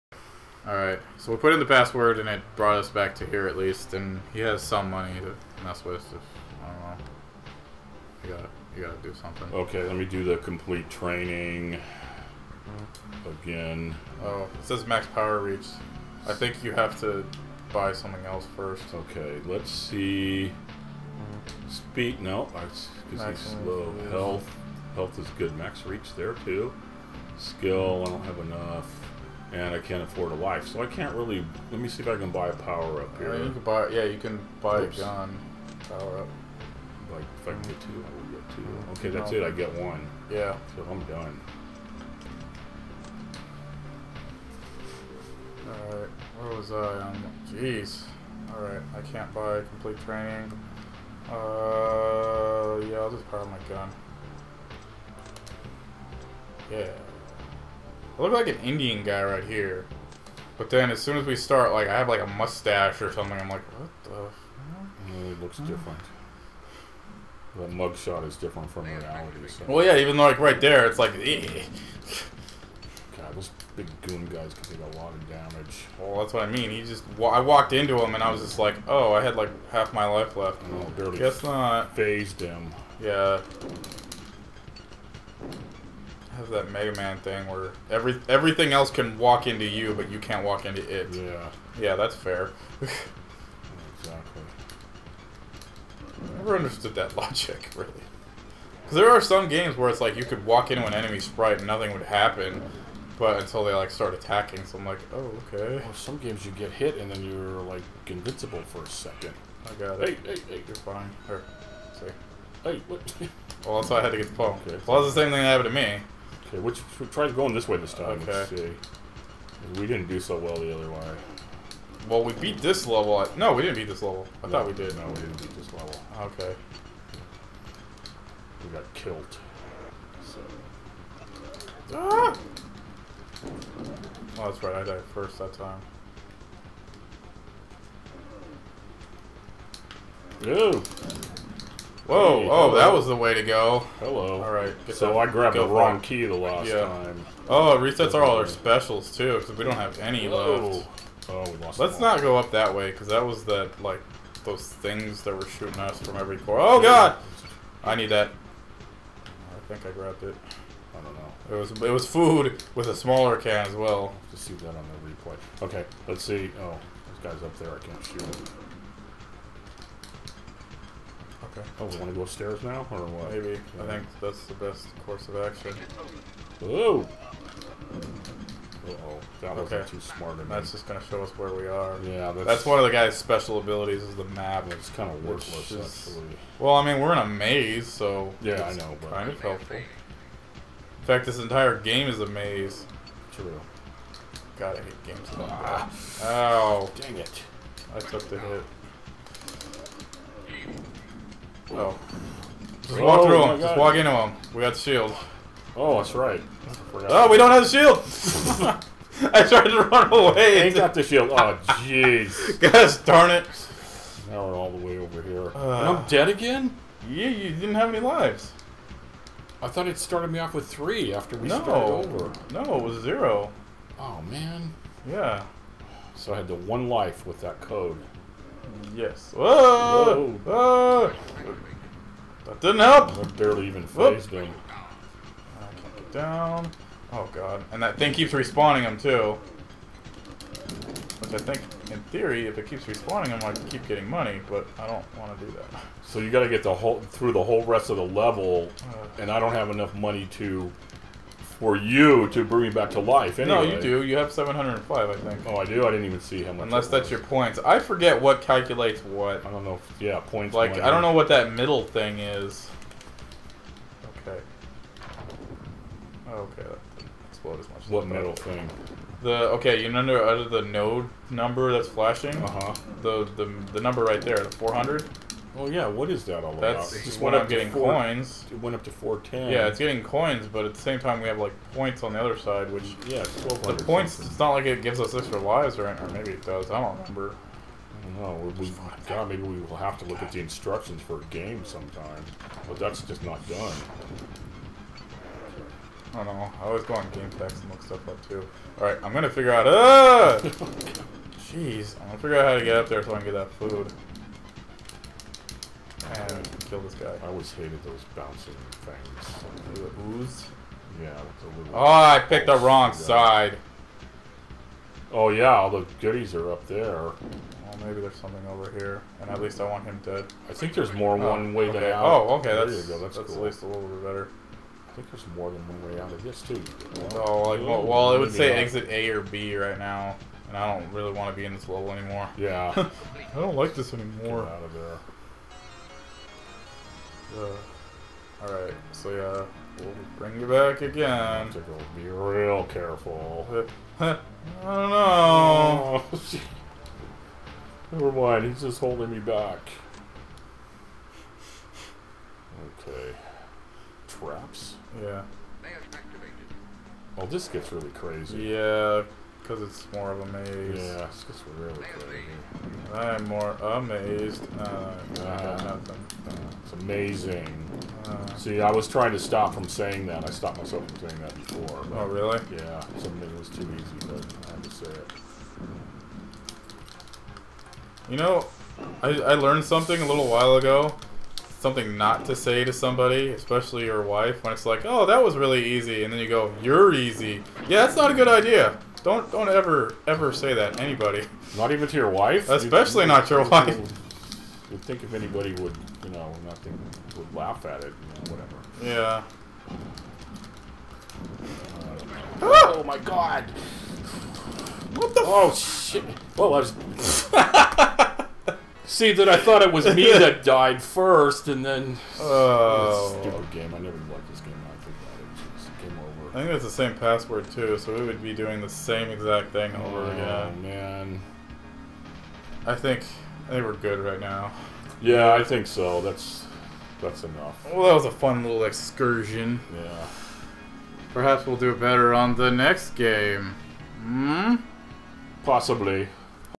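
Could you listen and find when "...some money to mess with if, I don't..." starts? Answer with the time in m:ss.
0:04.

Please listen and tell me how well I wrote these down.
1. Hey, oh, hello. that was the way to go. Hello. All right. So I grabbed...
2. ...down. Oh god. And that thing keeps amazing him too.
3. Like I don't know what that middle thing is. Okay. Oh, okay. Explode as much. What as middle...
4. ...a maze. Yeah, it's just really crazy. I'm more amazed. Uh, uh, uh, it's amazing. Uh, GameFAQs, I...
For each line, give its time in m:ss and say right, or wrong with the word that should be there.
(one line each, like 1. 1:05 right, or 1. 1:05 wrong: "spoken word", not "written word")
1. 2:22 right
2. 3:56 wrong: "respawning", not "amazing"
3. 4:20 right
4. 6:00 wrong: "See", not "GameFAQs".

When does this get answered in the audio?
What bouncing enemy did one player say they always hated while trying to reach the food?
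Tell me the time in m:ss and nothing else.
5:09.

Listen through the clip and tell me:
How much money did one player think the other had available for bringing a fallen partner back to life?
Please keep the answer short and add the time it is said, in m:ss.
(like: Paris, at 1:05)
705, at 4:14.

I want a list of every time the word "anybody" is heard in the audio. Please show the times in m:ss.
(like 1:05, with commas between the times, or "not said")
6:30, 6:35.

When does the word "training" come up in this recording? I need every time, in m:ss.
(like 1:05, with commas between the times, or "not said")
0:10, 0:50.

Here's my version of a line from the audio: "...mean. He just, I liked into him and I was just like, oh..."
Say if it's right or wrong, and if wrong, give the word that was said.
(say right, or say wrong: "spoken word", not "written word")
wrong: "walked", not "liked".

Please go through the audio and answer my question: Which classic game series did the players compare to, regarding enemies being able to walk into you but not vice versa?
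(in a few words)
Mega Man.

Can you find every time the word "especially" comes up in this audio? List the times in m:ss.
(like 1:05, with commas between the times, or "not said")
6:23, 6:32.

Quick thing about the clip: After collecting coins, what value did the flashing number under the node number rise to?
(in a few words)
410.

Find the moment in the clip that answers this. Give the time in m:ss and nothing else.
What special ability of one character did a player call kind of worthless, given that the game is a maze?
3:04.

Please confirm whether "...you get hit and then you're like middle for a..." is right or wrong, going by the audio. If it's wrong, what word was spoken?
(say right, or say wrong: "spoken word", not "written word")
wrong: "invincible", not "middle".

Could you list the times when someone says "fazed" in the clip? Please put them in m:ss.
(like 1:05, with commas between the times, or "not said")
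1:21, 3:53.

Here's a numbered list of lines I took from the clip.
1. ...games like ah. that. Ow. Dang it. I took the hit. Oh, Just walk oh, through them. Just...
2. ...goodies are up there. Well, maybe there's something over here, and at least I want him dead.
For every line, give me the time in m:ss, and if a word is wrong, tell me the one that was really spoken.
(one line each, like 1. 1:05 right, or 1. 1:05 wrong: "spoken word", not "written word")
1. 3:15 right
2. 5:15 right.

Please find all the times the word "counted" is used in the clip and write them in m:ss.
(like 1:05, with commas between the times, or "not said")
not said.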